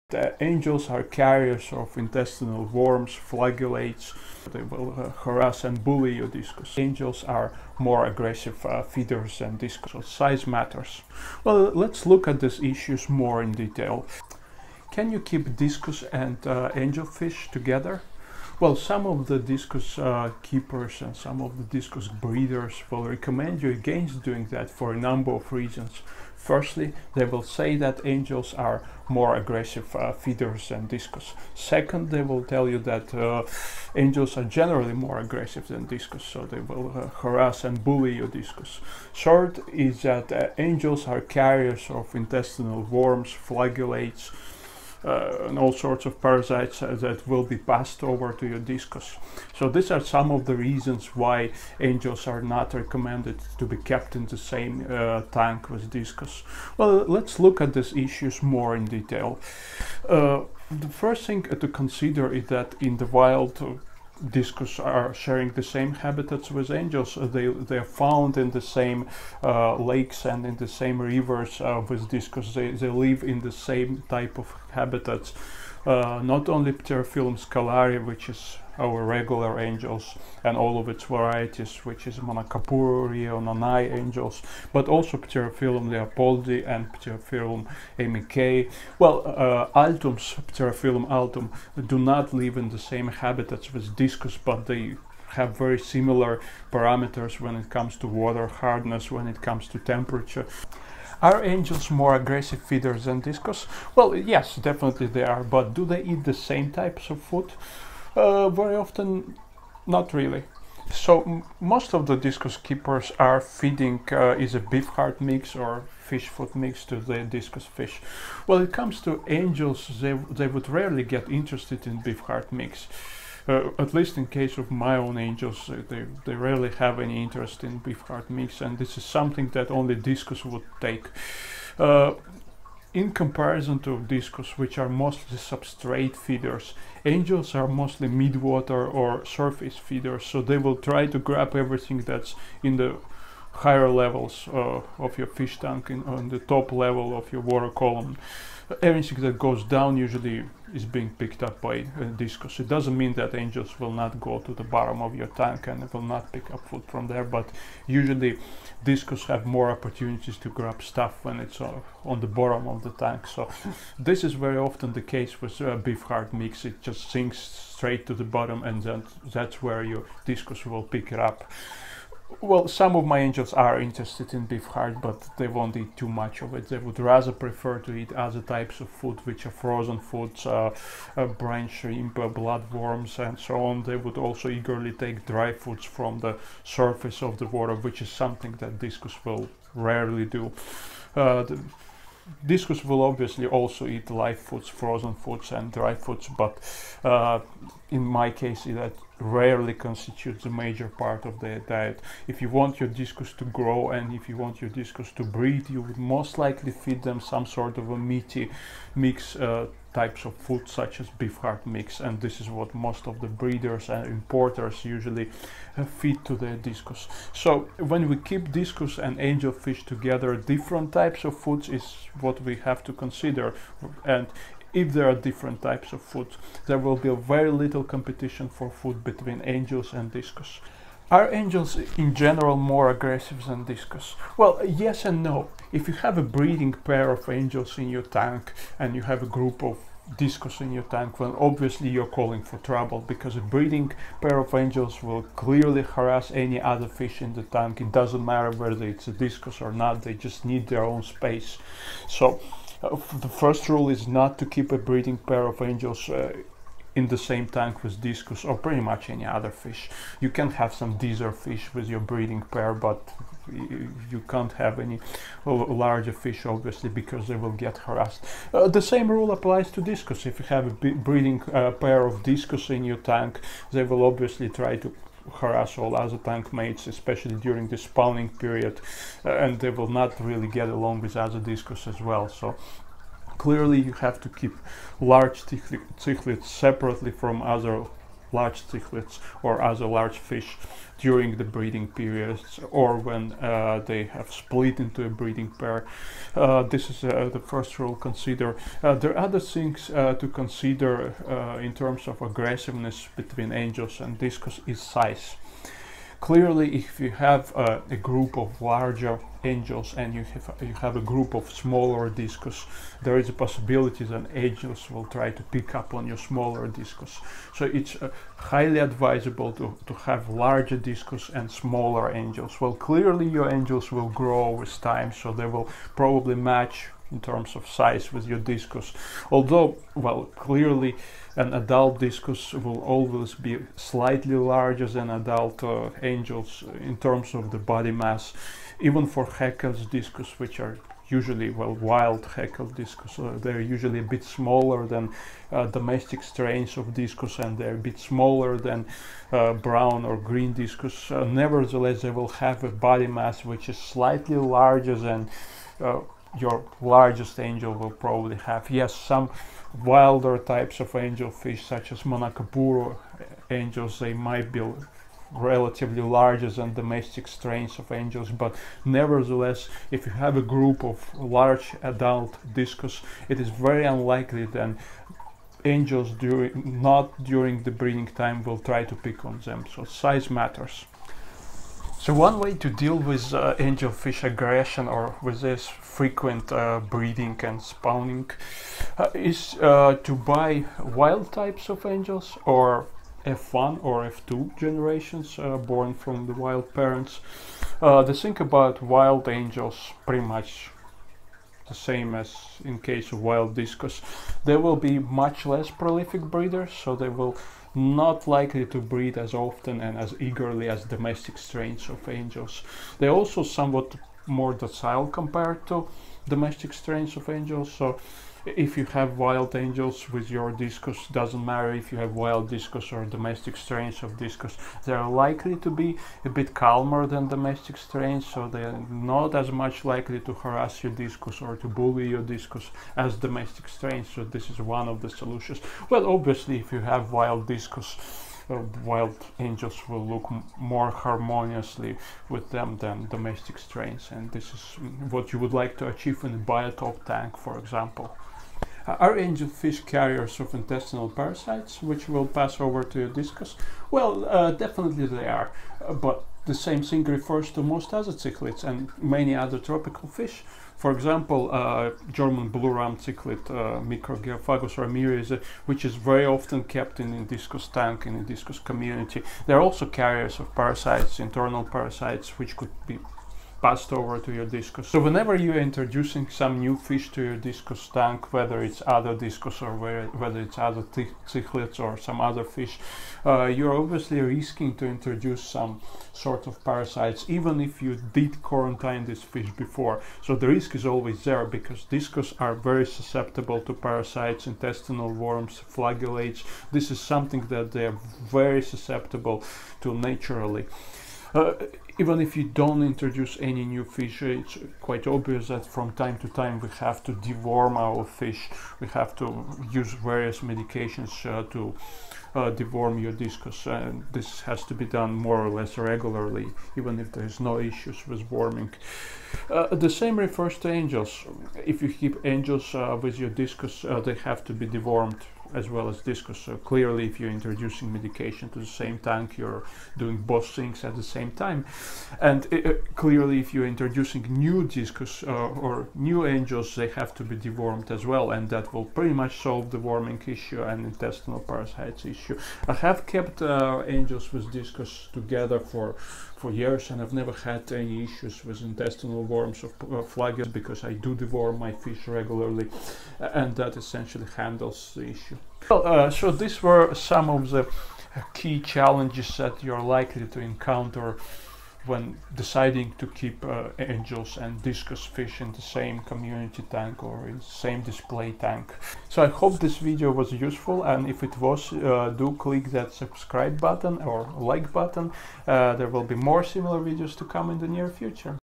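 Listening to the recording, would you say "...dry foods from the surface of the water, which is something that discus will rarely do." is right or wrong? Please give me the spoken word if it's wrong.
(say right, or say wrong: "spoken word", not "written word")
right.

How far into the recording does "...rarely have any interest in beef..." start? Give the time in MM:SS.
02:06.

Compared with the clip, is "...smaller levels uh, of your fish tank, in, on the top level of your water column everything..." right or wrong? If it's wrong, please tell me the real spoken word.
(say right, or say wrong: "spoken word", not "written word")
wrong: "higher", not "smaller".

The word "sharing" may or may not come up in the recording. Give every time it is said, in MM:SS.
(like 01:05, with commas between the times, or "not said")
01:05.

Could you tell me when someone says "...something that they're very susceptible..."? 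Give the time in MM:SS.
08:16.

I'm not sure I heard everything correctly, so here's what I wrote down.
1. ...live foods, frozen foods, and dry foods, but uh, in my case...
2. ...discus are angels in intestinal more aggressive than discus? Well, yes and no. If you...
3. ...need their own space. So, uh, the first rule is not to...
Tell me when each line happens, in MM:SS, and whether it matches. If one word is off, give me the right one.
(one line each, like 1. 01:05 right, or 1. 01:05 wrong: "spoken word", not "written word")
1. 03:14 right
2. 03:50 wrong: "general", not "intestinal"
3. 04:10 right.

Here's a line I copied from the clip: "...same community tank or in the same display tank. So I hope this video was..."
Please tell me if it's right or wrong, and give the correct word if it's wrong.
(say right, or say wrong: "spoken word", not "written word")
right.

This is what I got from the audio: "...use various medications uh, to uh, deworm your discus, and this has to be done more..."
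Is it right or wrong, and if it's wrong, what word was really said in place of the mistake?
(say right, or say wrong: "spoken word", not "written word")
right.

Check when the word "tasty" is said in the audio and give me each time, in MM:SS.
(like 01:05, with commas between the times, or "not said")
not said.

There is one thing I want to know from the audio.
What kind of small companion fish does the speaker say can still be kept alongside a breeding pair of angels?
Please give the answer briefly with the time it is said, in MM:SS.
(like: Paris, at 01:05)
dither fish, at 04:20.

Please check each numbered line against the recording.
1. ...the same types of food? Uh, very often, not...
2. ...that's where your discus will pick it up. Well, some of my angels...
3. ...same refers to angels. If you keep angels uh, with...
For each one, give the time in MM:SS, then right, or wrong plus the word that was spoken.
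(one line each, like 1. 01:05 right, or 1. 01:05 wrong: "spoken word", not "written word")
1. 01:46 right
2. 02:49 right
3. 08:39 right.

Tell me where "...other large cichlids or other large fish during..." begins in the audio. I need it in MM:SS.
04:47.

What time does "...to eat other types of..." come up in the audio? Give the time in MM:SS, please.
02:57.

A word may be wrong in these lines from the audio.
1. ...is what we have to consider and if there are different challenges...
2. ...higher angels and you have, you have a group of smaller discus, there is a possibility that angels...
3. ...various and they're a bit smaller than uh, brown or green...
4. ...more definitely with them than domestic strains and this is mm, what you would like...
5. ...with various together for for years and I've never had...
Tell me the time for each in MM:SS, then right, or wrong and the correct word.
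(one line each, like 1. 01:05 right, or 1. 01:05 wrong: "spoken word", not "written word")
1. 03:41 wrong: "types", not "challenges"
2. 05:08 wrong: "larger", not "higher"
3. 05:46 wrong: "discus", not "various"
4. 07:20 wrong: "harmoniously", not "definitely"
5. 09:04 wrong: "discus", not "various".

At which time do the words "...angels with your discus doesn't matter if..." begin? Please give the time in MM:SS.
06:59.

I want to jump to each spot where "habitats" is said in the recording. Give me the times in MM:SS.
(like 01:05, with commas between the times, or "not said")
01:05, 01:14, 01:33.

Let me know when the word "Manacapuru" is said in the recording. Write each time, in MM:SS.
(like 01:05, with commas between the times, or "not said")
01:22, 06:02.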